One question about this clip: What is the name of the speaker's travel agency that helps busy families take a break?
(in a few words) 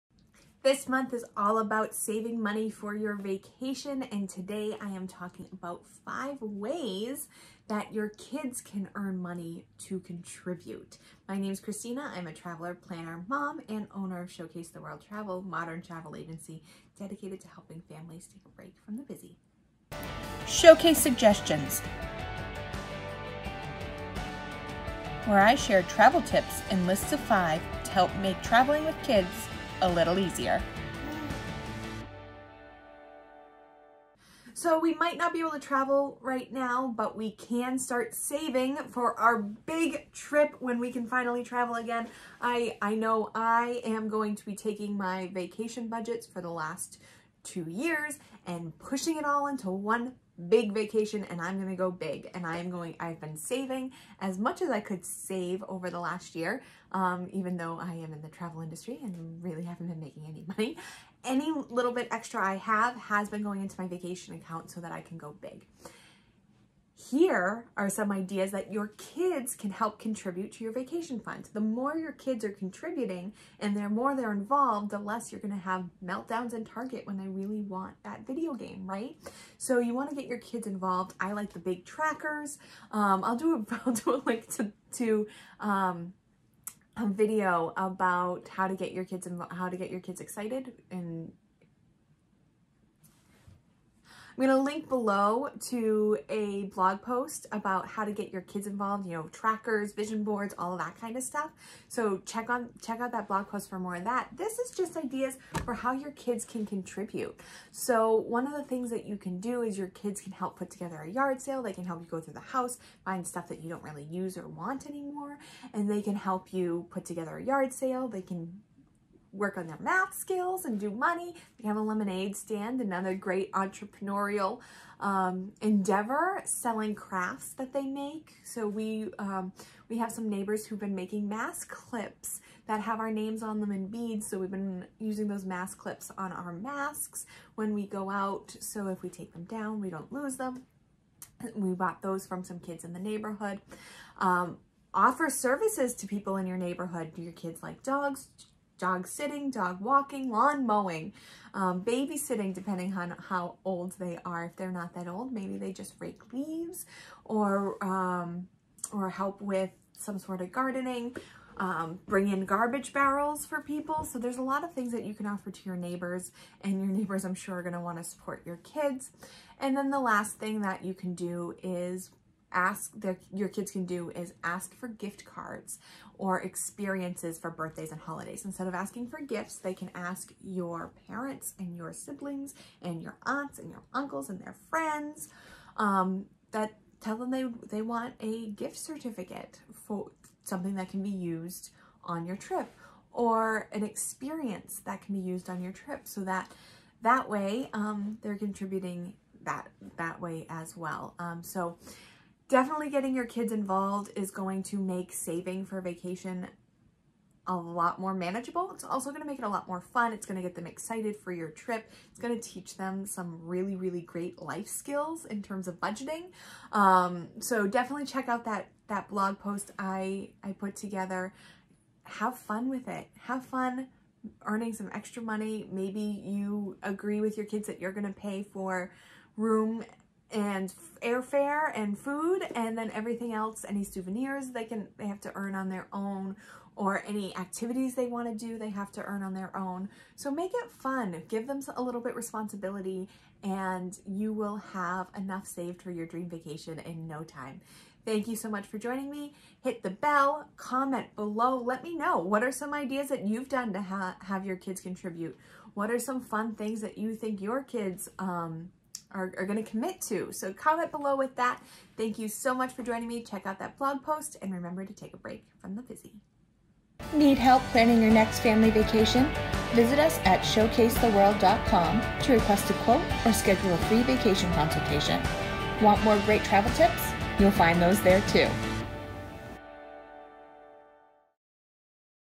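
Showcase the World Travel.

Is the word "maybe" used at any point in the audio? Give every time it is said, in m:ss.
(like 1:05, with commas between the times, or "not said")
2:35, 3:45.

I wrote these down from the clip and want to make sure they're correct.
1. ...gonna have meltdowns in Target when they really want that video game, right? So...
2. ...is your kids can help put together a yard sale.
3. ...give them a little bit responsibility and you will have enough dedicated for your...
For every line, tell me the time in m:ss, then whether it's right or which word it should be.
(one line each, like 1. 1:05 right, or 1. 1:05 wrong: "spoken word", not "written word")
1. 1:15 right
2. 1:49 right
3. 4:01 wrong: "saved", not "dedicated".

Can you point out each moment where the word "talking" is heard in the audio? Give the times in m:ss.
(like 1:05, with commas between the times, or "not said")
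0:05.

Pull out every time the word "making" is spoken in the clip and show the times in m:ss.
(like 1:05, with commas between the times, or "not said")
0:59, 2:10.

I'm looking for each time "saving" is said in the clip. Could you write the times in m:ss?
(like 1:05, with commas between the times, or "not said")
0:01, 0:38, 0:53, 3:25.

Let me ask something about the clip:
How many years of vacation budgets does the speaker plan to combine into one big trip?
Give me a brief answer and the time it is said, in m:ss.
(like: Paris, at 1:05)
2, at 0:47.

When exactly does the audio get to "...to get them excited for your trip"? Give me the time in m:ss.
3:30.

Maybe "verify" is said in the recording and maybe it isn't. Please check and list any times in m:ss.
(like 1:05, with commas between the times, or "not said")
not said.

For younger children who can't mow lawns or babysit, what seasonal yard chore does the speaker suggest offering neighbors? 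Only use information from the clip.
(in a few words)
rake leaves.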